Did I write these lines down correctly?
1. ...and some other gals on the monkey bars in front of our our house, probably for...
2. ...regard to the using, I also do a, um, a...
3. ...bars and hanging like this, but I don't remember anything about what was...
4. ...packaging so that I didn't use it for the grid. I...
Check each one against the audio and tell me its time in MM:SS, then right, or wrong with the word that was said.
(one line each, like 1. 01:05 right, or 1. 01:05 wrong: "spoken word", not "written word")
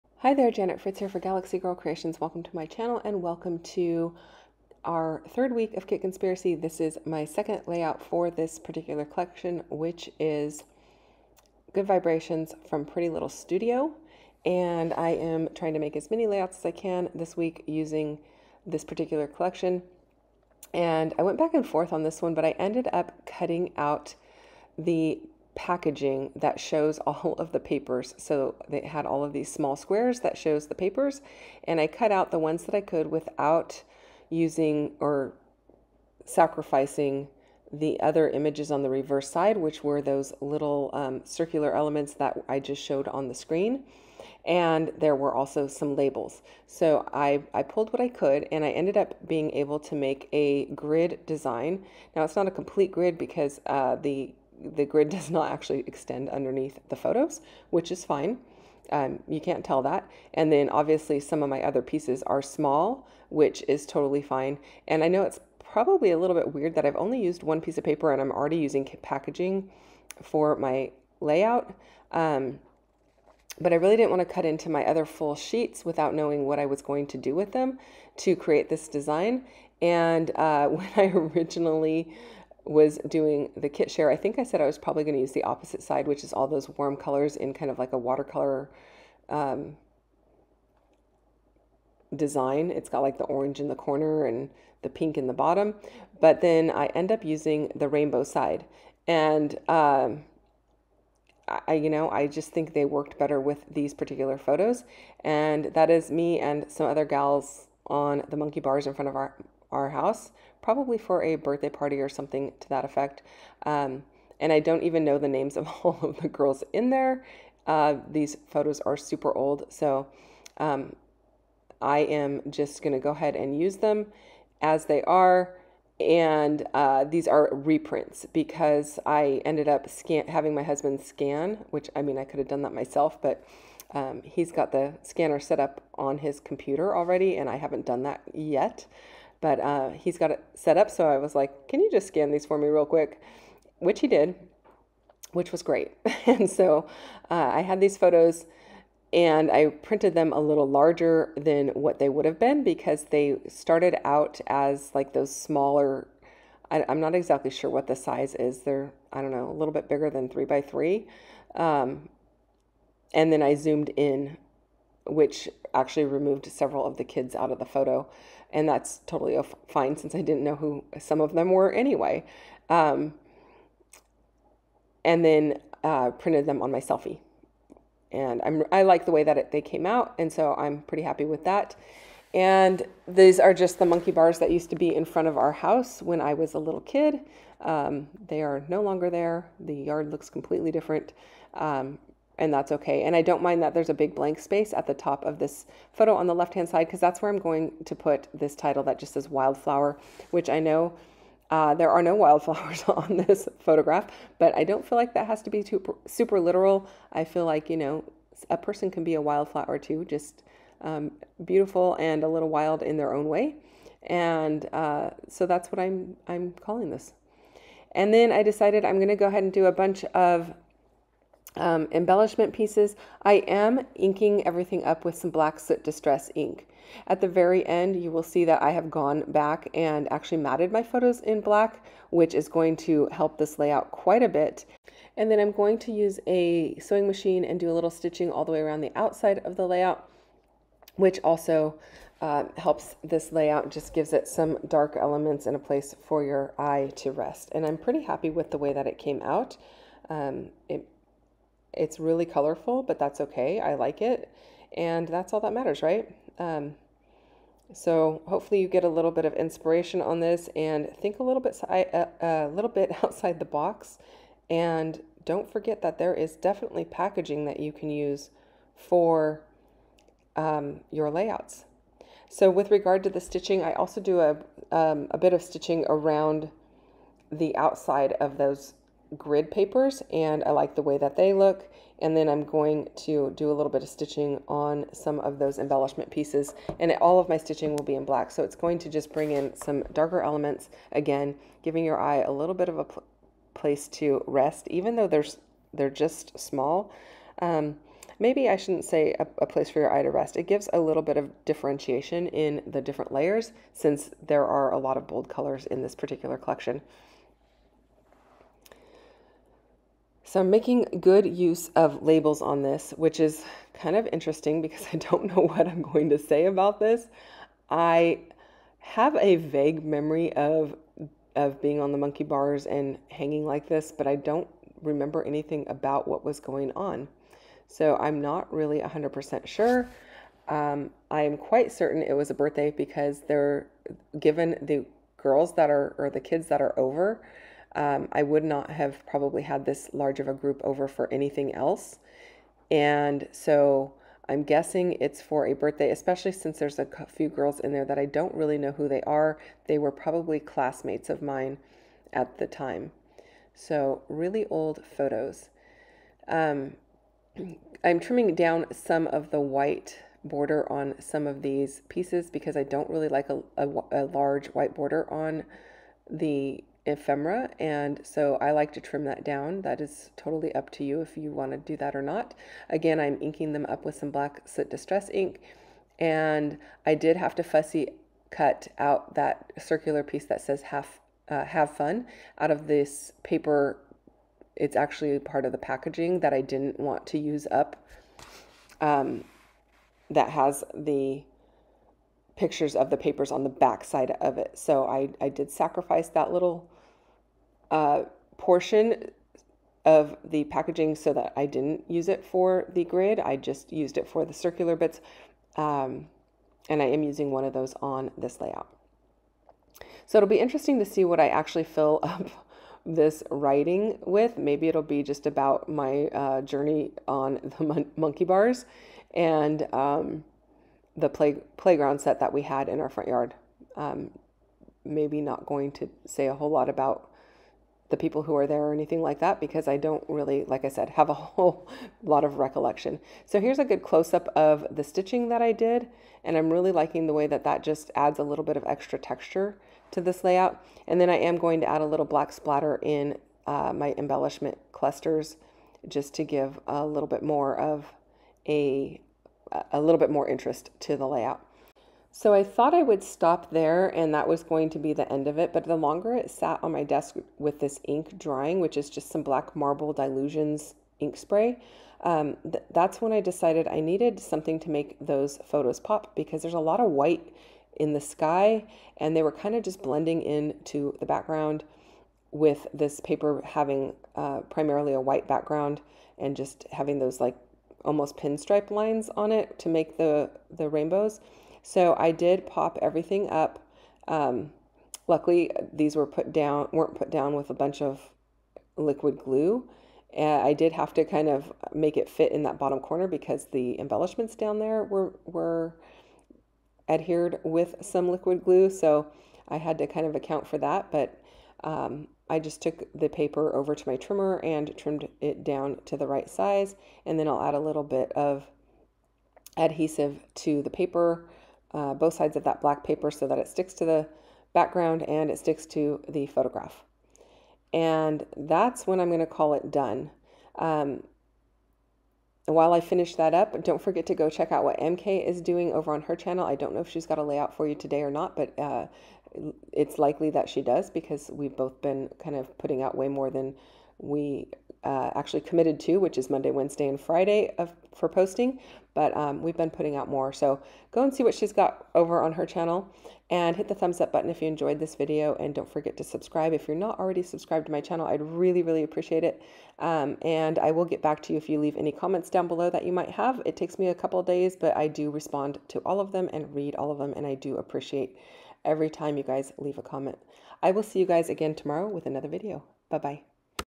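1. 01:46 right
2. 04:32 wrong: "stitching", not "using"
3. 05:22 right
4. 06:40 right.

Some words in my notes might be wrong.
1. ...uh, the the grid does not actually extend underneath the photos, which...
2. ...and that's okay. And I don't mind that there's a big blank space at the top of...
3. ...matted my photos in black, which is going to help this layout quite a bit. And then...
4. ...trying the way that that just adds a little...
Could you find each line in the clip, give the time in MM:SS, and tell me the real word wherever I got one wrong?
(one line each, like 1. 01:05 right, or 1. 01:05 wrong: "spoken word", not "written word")
1. 00:53 right
2. 03:12 right
3. 03:50 right
4. 07:16 wrong: "liking", not "trying".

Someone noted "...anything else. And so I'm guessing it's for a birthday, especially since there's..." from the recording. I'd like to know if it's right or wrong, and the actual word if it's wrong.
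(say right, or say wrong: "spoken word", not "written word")
right.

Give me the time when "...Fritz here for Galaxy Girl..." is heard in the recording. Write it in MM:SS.
00:00.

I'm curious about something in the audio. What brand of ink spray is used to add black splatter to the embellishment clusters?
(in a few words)
Dylusions.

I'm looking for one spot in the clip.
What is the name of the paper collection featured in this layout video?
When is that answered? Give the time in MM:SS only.
00:11.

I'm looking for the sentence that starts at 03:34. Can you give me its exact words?
And uh, so that's what I'm, I'm calling this.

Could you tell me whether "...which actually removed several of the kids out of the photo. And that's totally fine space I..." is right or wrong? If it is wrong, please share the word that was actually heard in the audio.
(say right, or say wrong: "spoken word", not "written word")
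wrong: "since", not "space".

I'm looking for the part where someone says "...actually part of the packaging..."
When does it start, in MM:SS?
06:24.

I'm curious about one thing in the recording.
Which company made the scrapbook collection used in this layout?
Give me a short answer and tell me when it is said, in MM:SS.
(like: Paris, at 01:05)
Pretty Little Studio, at 00:12.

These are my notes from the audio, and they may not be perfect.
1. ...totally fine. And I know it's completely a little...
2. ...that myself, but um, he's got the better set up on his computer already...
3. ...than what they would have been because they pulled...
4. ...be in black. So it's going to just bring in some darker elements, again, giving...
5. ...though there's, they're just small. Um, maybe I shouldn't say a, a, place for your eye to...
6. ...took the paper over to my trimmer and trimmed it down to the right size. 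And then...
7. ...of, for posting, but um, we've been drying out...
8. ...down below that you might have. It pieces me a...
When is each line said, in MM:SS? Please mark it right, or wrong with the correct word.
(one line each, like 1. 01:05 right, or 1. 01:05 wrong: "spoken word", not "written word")
1. 01:03 wrong: "probably", not "completely"
2. 02:12 wrong: "scanner", not "better"
3. 02:31 wrong: "started", not "pulled"
4. 04:47 right
5. 04:54 right
6. 08:22 right
7. 08:57 wrong: "putting", not "drying"
8. 09:12 wrong: "takes", not "pieces".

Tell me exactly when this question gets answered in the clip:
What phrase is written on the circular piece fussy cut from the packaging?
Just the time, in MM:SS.
06:21.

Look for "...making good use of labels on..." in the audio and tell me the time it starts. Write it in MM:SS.
05:10.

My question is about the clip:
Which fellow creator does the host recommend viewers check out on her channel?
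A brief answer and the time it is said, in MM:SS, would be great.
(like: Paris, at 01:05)
MK, at 08:44.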